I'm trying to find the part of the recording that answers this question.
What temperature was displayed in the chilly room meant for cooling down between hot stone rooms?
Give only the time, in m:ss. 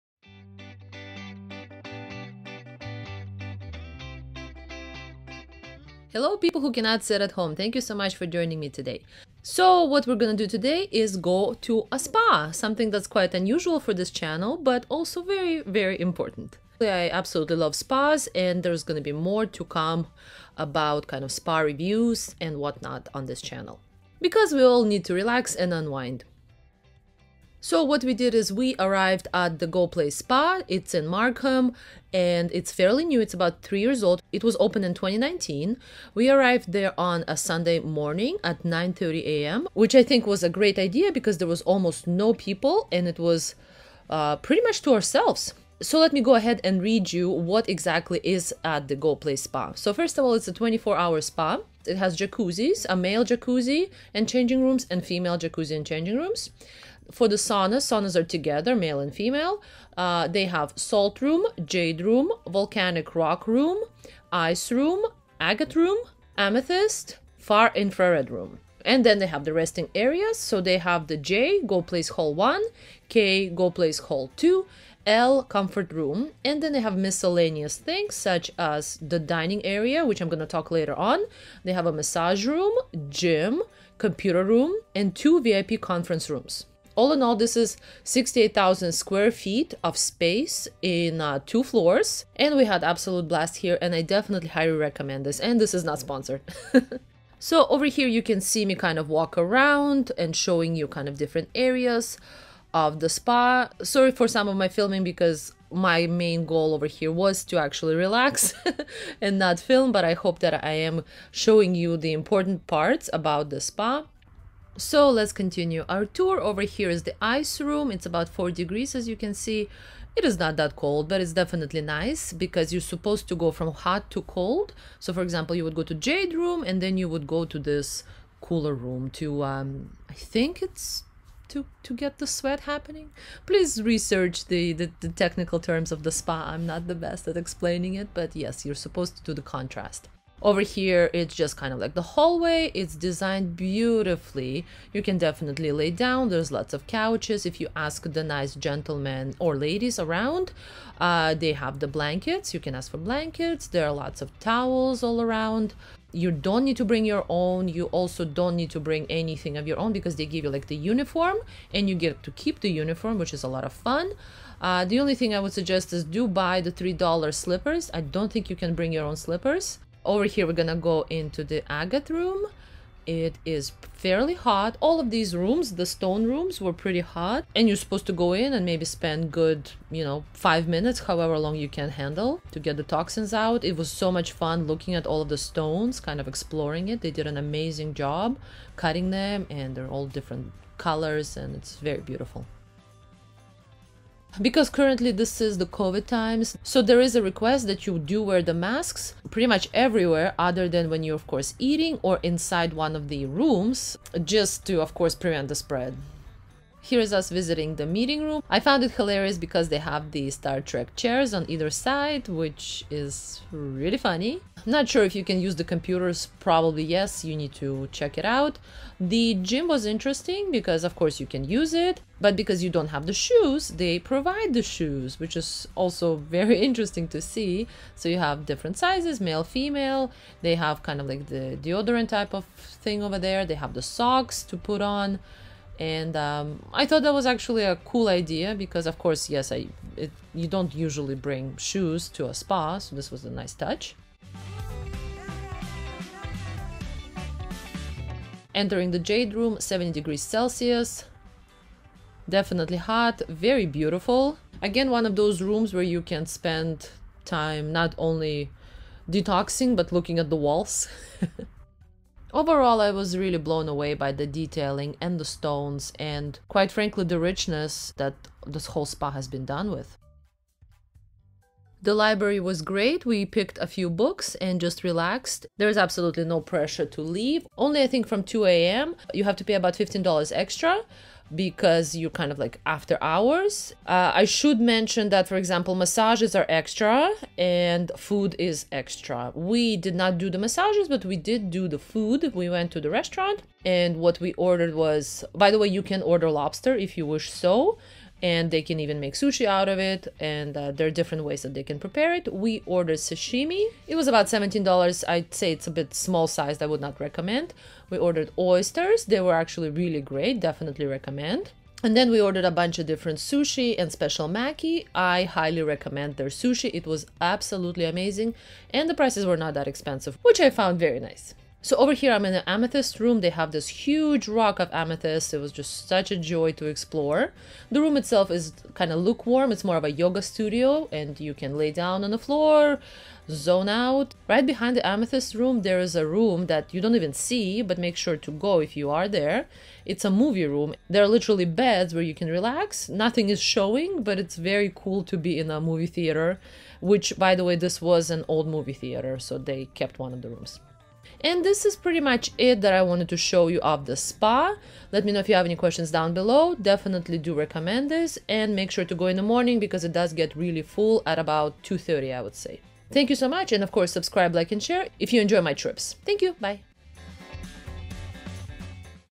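1:58.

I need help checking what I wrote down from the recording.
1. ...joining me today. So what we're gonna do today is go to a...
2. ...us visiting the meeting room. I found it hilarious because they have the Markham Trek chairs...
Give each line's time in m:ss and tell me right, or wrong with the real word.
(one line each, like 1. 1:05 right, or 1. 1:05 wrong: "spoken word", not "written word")
1. 0:08 right
2. 3:27 wrong: "Star", not "Markham".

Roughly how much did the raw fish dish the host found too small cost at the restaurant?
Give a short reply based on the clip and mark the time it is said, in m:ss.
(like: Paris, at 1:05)
$17, at 5:04.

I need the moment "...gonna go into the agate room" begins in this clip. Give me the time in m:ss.
2:50.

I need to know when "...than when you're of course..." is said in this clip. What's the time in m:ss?
3:20.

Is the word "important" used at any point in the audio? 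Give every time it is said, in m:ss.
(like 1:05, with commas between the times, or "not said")
0:16, 1:52.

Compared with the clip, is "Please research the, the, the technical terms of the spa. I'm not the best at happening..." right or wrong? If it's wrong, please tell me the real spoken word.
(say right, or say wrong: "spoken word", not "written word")
wrong: "explaining", not "happening".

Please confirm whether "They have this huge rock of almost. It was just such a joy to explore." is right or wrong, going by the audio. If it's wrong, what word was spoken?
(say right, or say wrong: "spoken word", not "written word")
wrong: "amethyst", not "almost".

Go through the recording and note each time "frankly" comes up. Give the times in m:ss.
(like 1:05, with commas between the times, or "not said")
4:26.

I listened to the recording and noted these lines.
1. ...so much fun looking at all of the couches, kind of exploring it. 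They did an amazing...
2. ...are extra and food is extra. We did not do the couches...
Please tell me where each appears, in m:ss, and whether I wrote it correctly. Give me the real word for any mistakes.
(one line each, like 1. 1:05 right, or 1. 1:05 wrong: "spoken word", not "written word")
1. 3:03 wrong: "stones", not "couches"
2. 4:46 wrong: "massages", not "couches".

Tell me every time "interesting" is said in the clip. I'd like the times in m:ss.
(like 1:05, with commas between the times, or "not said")
3:39, 3:46.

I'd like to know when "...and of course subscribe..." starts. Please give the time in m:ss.
6:03.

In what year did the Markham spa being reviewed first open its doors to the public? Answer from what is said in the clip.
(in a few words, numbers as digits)
2019.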